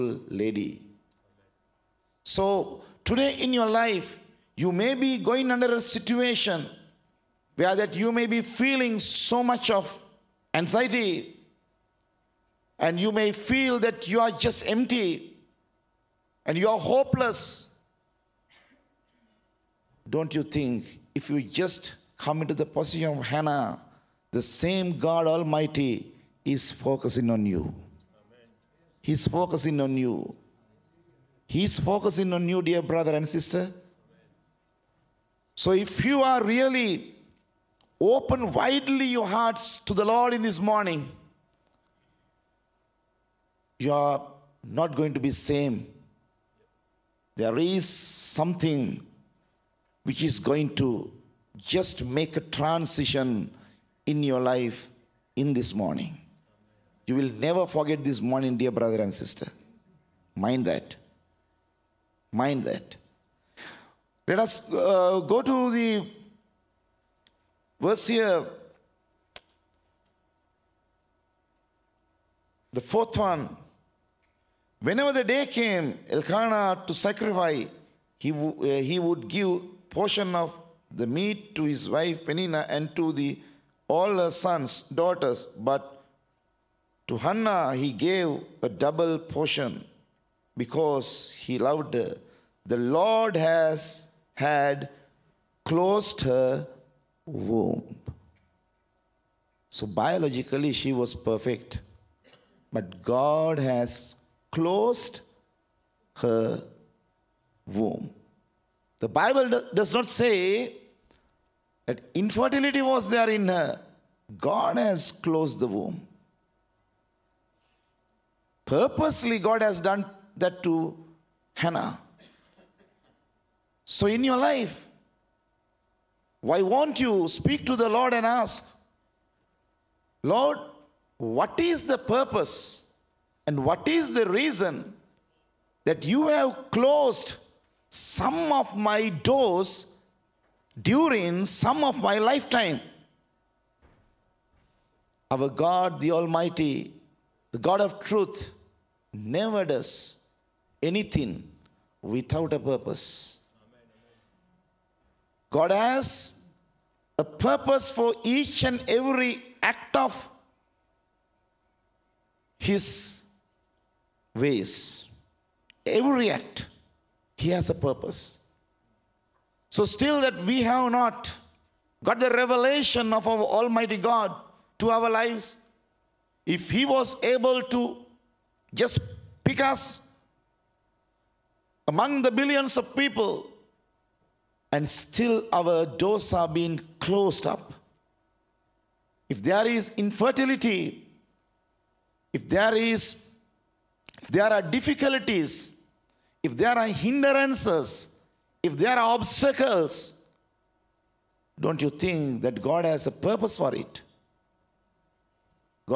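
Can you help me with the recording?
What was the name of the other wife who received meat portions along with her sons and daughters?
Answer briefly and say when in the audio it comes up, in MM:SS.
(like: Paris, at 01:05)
Penina, at 01:22.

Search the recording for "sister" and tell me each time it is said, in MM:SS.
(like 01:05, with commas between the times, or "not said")
00:33, 00:59.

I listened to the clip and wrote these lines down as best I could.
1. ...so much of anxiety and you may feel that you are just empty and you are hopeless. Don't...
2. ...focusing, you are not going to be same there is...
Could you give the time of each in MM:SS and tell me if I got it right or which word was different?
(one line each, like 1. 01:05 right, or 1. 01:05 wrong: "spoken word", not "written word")
1. 00:09 right
2. 00:40 wrong: "morning", not "focusing".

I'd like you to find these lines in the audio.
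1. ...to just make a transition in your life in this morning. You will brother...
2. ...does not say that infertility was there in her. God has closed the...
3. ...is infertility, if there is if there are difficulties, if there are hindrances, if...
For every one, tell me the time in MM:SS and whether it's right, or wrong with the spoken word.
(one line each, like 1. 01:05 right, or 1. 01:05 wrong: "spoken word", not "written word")
1. 00:50 wrong: "never", not "brother"
2. 01:49 right
3. 03:09 right.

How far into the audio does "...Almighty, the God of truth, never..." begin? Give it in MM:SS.
02:26.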